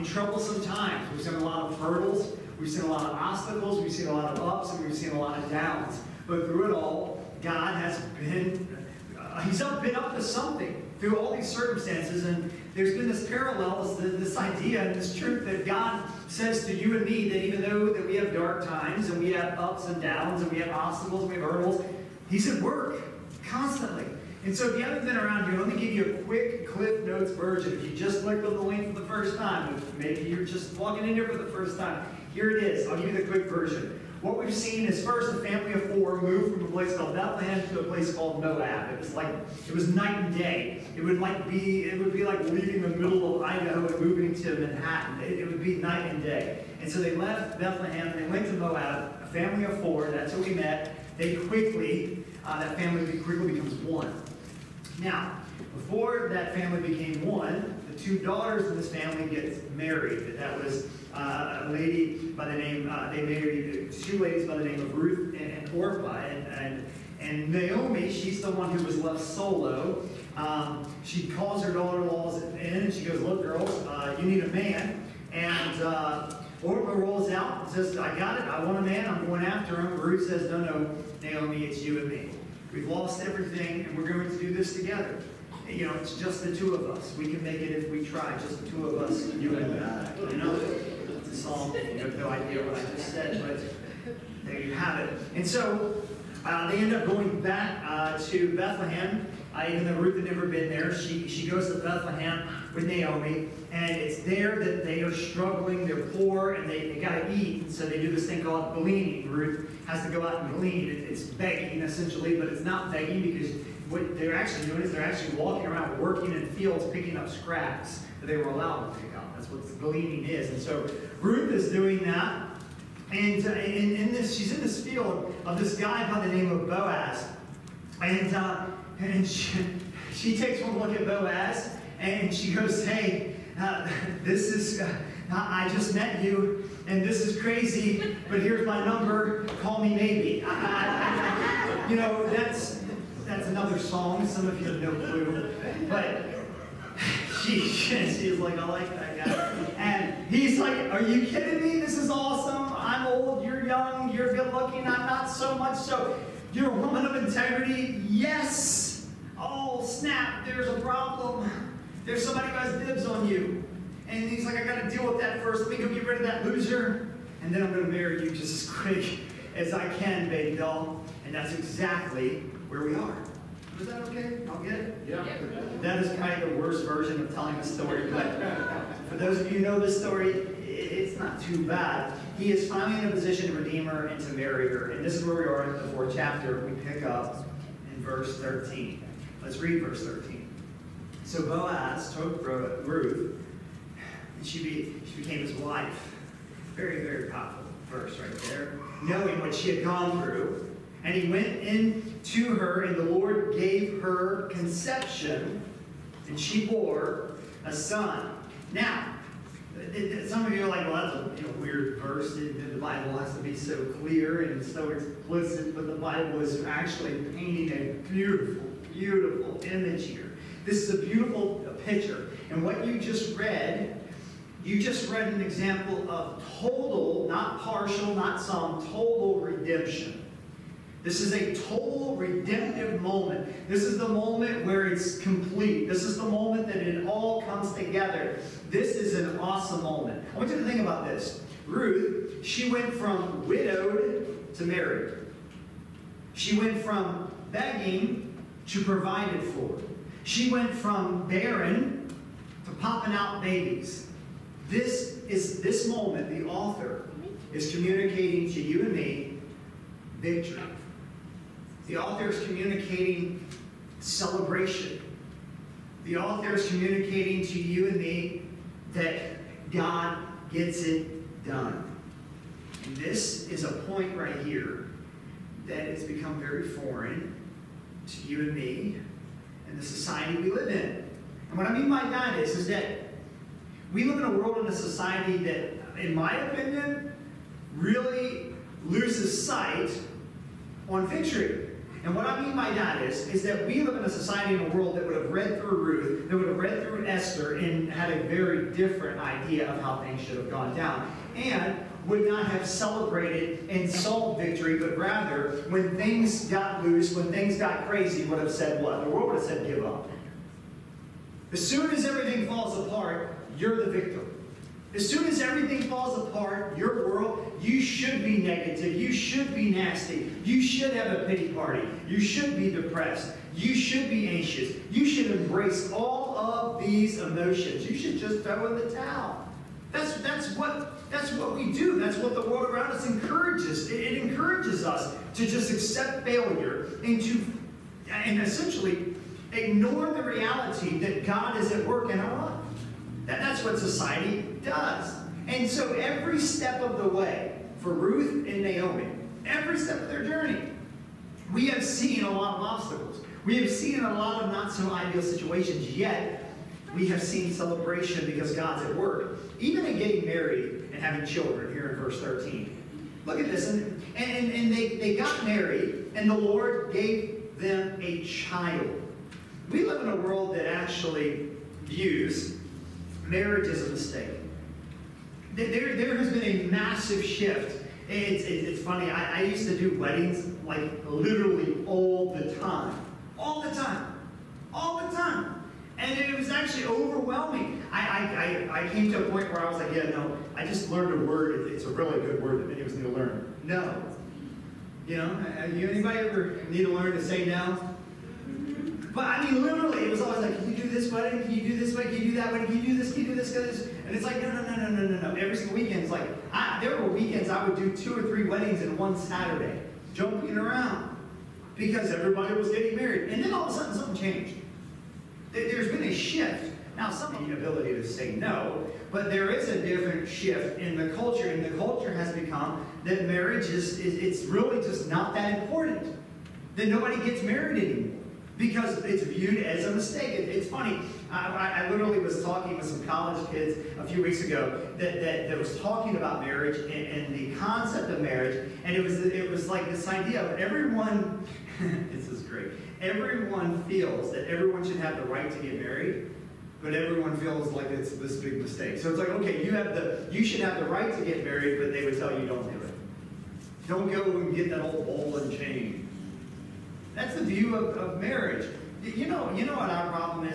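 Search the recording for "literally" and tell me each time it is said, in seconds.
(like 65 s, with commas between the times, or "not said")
381 s, 399 s, 431 s.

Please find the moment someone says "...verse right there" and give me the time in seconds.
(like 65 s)
197 s.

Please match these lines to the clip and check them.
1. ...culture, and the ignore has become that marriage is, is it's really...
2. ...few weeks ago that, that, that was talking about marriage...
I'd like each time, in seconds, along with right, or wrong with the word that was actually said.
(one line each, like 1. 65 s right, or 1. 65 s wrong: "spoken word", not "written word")
1. 421 s wrong: "culture", not "ignore"
2. 434 s right.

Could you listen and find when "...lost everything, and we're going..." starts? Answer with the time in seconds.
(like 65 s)
82 s.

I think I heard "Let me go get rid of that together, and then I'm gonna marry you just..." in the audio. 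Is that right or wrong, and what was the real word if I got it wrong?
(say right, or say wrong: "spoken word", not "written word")
wrong: "loser", not "together".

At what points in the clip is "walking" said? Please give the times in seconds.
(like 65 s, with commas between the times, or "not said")
30 s, 115 s.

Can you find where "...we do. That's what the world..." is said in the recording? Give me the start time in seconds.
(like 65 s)
331 s.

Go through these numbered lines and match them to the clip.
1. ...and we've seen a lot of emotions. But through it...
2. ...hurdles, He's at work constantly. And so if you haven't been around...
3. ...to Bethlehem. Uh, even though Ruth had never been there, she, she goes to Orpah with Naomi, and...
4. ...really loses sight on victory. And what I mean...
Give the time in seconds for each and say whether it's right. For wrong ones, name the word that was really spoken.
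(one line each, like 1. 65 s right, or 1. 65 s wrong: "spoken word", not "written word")
1. 4 s wrong: "downs", not "emotions"
2. 21 s right
3. 98 s wrong: "Bethlehem", not "Orpah"
4. 287 s right.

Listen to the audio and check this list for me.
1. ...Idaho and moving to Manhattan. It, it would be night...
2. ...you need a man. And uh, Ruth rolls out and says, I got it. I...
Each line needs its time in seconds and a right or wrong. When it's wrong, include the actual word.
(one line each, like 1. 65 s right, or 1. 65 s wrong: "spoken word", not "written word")
1. 43 s right
2. 74 s wrong: "Orpah", not "Ruth".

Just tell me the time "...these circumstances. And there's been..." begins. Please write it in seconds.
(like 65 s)
11 s.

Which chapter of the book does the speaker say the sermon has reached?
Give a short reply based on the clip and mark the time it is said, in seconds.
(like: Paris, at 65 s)
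fourth chapter, at 185 s.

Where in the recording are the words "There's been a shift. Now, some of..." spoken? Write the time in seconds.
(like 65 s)
415 s.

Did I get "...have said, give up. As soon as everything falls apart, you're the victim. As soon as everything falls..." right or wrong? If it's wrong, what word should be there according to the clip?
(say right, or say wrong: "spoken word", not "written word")
right.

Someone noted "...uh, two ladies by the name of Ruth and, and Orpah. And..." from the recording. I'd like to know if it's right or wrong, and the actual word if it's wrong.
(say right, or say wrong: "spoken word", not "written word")
right.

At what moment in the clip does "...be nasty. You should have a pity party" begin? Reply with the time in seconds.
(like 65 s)
319 s.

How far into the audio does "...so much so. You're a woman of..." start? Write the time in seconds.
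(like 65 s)
155 s.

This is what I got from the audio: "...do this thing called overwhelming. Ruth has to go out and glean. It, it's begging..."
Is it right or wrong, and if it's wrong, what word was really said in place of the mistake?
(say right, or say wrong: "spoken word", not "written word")
wrong: "gleaning", not "overwhelming".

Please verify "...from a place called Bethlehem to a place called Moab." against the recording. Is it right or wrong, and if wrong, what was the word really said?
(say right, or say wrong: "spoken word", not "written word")
right.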